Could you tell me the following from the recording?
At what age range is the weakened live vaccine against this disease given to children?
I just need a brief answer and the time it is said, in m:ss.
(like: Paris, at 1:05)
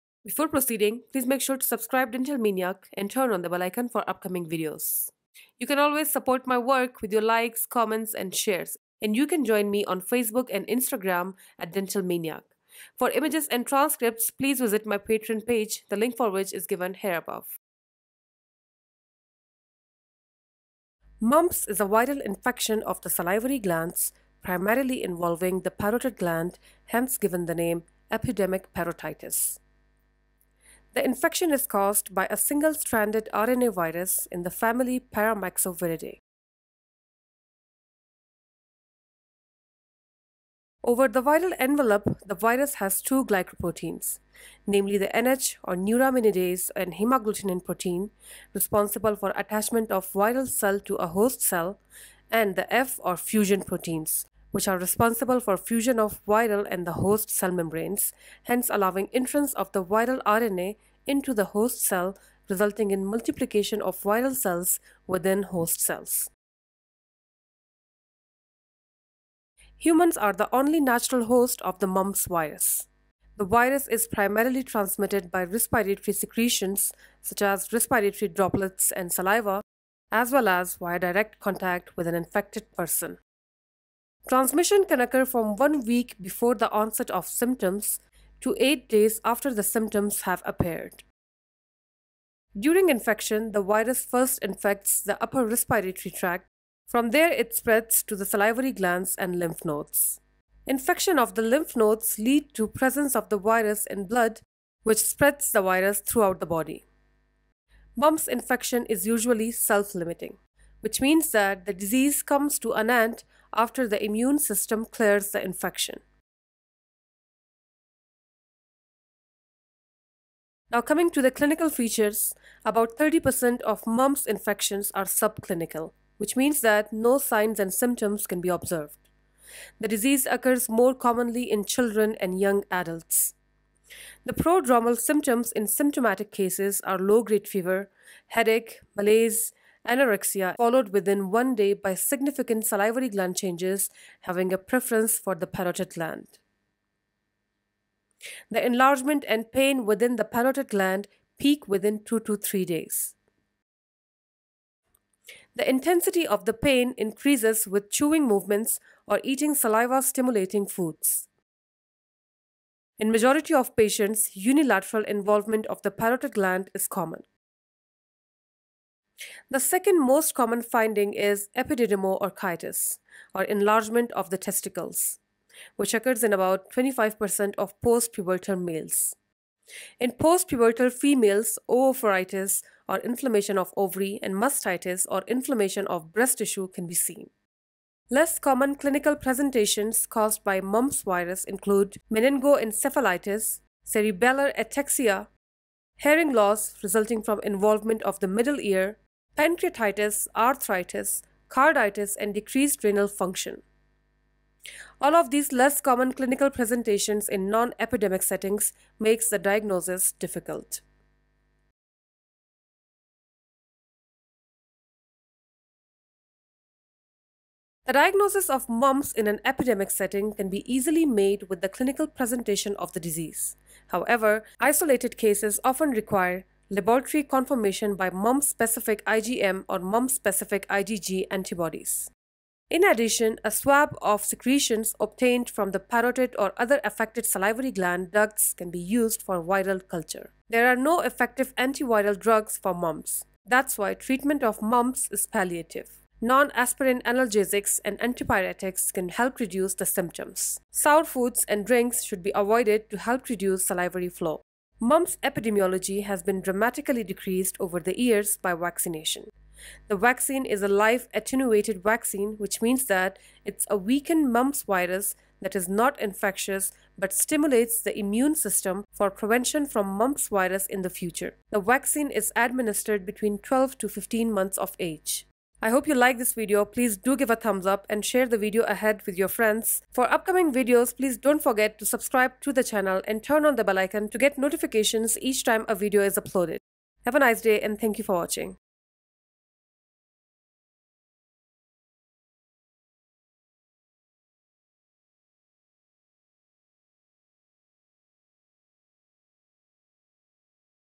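12 to 15 months, at 4:33.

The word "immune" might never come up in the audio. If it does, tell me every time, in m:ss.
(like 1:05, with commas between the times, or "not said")
1:54, 4:27.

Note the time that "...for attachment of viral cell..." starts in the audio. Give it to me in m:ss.
0:49.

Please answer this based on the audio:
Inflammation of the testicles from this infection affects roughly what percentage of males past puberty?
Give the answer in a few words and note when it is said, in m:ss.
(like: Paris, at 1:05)
25%, at 2:56.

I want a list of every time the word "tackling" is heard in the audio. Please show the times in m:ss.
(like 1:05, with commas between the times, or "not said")
not said.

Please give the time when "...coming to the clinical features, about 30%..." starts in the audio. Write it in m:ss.
2:00.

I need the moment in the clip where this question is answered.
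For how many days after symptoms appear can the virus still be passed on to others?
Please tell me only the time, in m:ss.
1:28.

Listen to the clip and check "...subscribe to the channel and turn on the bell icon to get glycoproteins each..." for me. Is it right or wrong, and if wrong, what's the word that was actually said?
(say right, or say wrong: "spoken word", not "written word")
wrong: "notifications", not "glycoproteins".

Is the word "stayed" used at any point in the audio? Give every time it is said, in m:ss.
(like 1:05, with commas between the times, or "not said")
not said.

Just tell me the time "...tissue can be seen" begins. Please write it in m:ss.
3:06.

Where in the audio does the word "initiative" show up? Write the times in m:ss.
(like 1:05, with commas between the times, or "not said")
not said.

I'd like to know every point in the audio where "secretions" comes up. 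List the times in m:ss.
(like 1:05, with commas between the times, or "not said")
1:16, 3:54.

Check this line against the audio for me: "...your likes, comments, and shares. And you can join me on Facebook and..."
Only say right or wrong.
right.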